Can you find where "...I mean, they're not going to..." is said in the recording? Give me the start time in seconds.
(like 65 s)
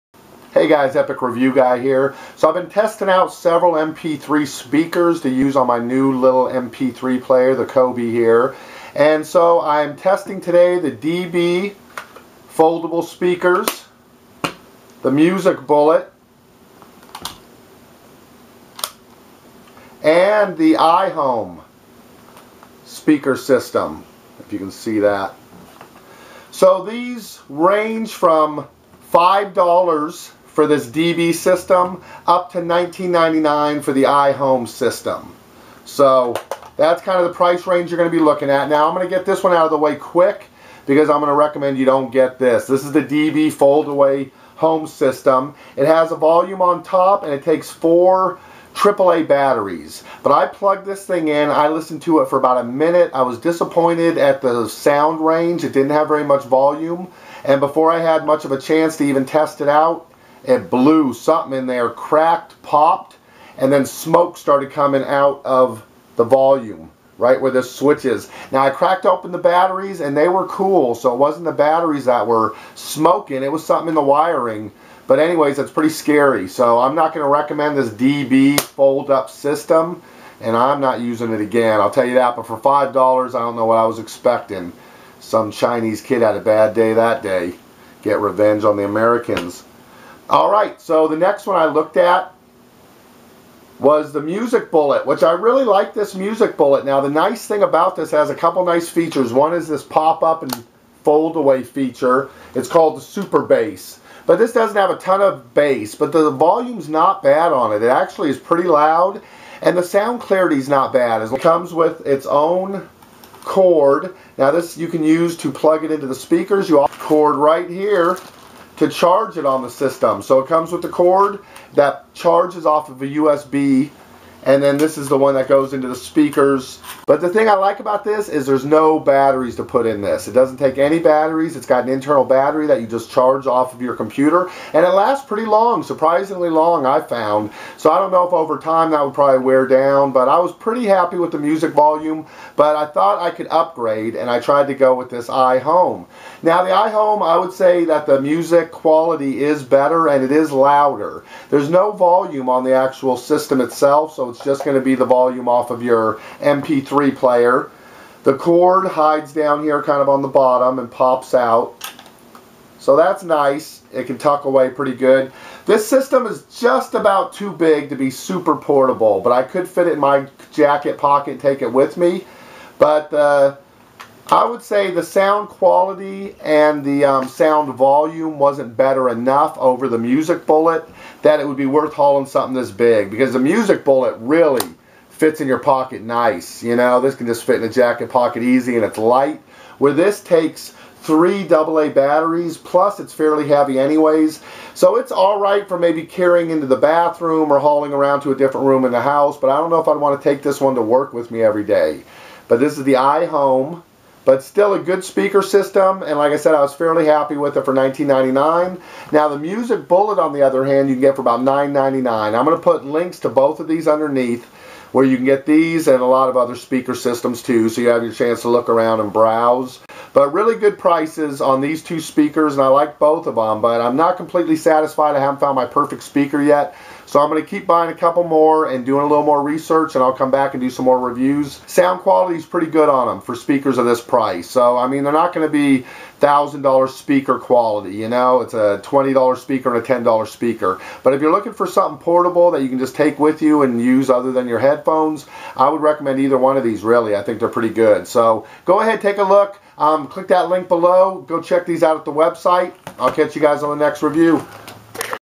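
234 s.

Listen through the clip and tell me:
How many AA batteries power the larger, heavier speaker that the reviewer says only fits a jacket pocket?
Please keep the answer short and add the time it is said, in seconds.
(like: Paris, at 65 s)
3, at 191 s.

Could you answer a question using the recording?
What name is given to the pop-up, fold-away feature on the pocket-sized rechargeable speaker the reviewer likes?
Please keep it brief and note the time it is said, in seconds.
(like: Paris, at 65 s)
Super Bass, at 103 s.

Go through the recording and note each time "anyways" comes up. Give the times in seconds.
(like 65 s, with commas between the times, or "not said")
75 s, 193 s.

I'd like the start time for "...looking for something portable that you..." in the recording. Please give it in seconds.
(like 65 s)
241 s.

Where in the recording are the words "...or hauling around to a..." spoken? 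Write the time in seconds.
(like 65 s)
197 s.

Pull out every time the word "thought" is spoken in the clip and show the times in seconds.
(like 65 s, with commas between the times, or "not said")
142 s.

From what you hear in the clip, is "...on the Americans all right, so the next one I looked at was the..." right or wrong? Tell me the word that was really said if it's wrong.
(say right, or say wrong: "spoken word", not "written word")
right.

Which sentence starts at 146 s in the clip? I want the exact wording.
Now, the iHome, I would say that the music quality is better and it is louder.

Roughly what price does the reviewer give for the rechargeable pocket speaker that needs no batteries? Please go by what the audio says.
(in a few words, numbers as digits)
$9.99.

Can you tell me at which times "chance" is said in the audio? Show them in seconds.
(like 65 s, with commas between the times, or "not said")
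58 s, 218 s.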